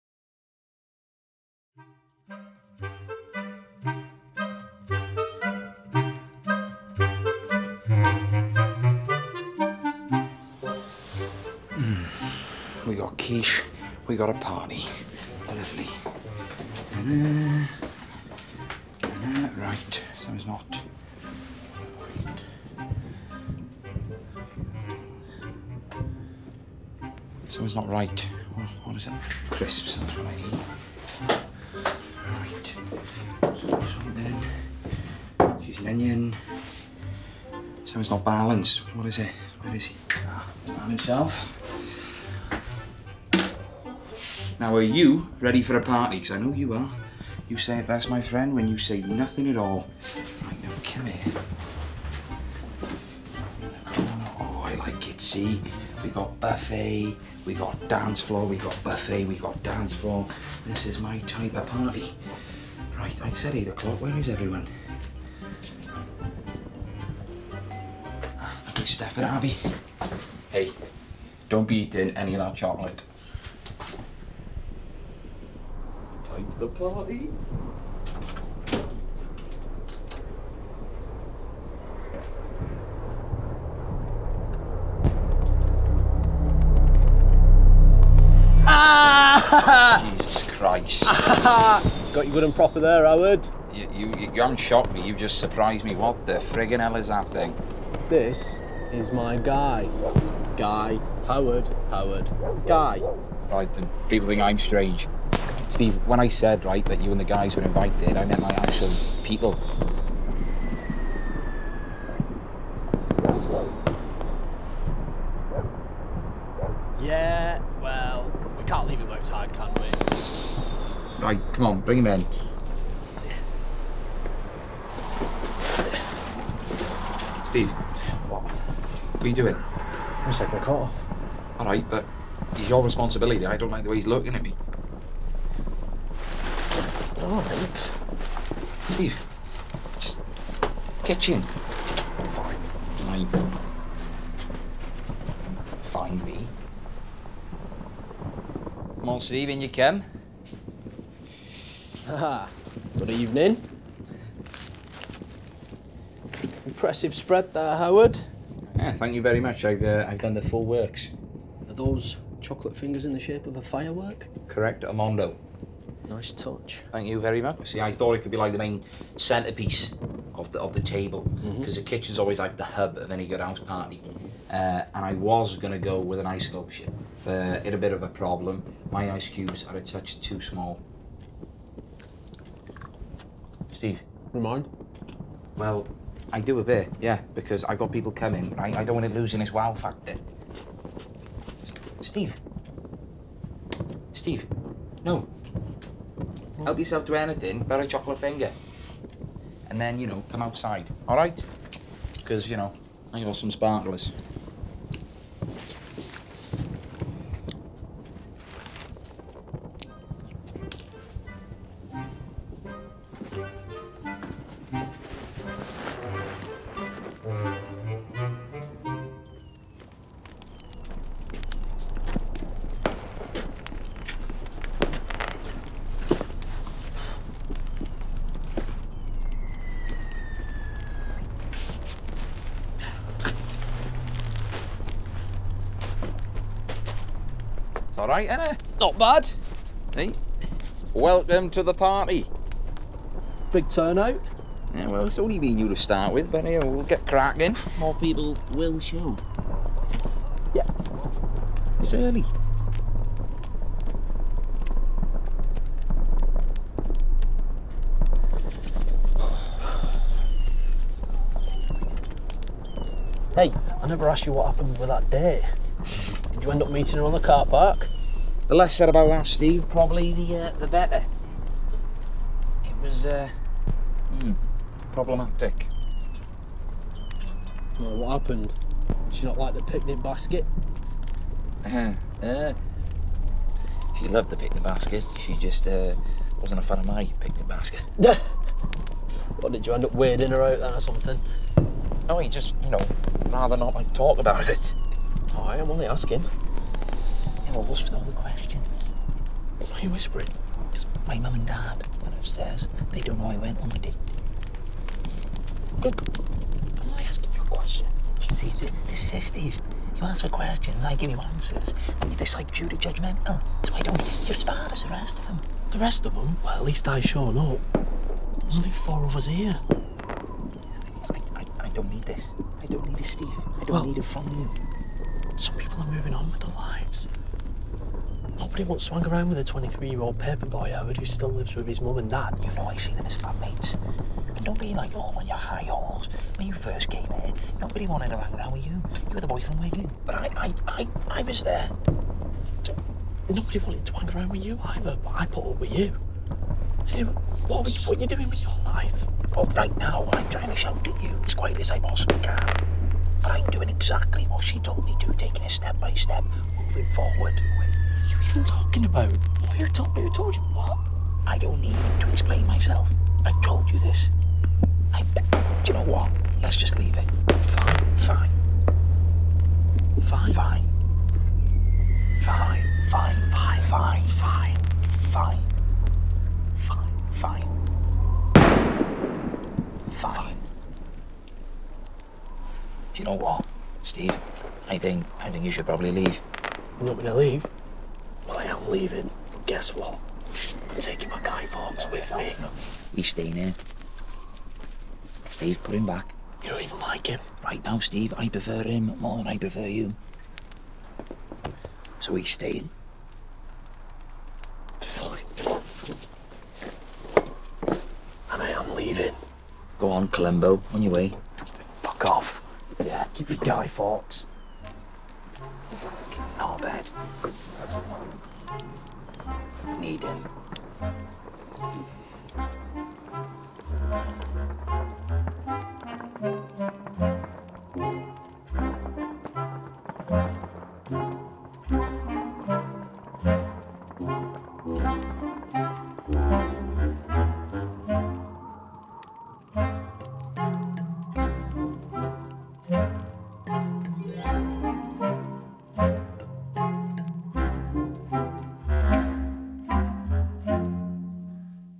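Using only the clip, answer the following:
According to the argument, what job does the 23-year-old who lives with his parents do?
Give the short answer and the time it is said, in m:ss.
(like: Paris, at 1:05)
Paper boy, at 5:30.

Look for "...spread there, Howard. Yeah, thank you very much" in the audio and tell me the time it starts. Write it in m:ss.
2:37.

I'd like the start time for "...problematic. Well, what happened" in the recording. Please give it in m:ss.
4:34.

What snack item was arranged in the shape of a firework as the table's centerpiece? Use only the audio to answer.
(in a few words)
Chocolate fingers.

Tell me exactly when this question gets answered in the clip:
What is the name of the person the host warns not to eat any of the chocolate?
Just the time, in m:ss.
1:09.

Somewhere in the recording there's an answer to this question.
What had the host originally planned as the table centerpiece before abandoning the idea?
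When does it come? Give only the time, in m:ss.
2:56.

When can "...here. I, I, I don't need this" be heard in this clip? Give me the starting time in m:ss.
5:19.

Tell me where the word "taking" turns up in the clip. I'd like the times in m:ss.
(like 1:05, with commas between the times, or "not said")
2:10, 5:55, 6:30.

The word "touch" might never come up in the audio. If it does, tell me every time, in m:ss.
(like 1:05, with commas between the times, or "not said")
2:46, 2:59.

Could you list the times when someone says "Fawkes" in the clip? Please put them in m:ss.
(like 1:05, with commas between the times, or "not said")
6:31, 6:53.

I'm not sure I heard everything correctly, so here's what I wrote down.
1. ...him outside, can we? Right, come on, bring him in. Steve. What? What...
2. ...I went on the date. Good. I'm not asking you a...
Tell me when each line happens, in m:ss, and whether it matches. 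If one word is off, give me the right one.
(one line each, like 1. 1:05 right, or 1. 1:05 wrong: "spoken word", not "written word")
1. 1:58 right
2. 5:03 right.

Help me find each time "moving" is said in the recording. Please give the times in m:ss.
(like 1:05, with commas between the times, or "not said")
5:25, 5:56.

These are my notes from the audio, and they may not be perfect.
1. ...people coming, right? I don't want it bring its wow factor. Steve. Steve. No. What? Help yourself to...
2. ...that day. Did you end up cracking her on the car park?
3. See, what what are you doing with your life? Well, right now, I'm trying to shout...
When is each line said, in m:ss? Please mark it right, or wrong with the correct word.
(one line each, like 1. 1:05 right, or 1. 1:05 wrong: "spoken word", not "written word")
1. 3:07 wrong: "losing", not "bring"
2. 4:24 wrong: "meeting", not "cracking"
3. 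5:46 right.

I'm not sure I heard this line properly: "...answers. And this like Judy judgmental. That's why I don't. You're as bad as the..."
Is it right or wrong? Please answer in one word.
right.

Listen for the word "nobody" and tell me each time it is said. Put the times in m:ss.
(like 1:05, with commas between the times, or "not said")
5:28, 5:37, 5:43.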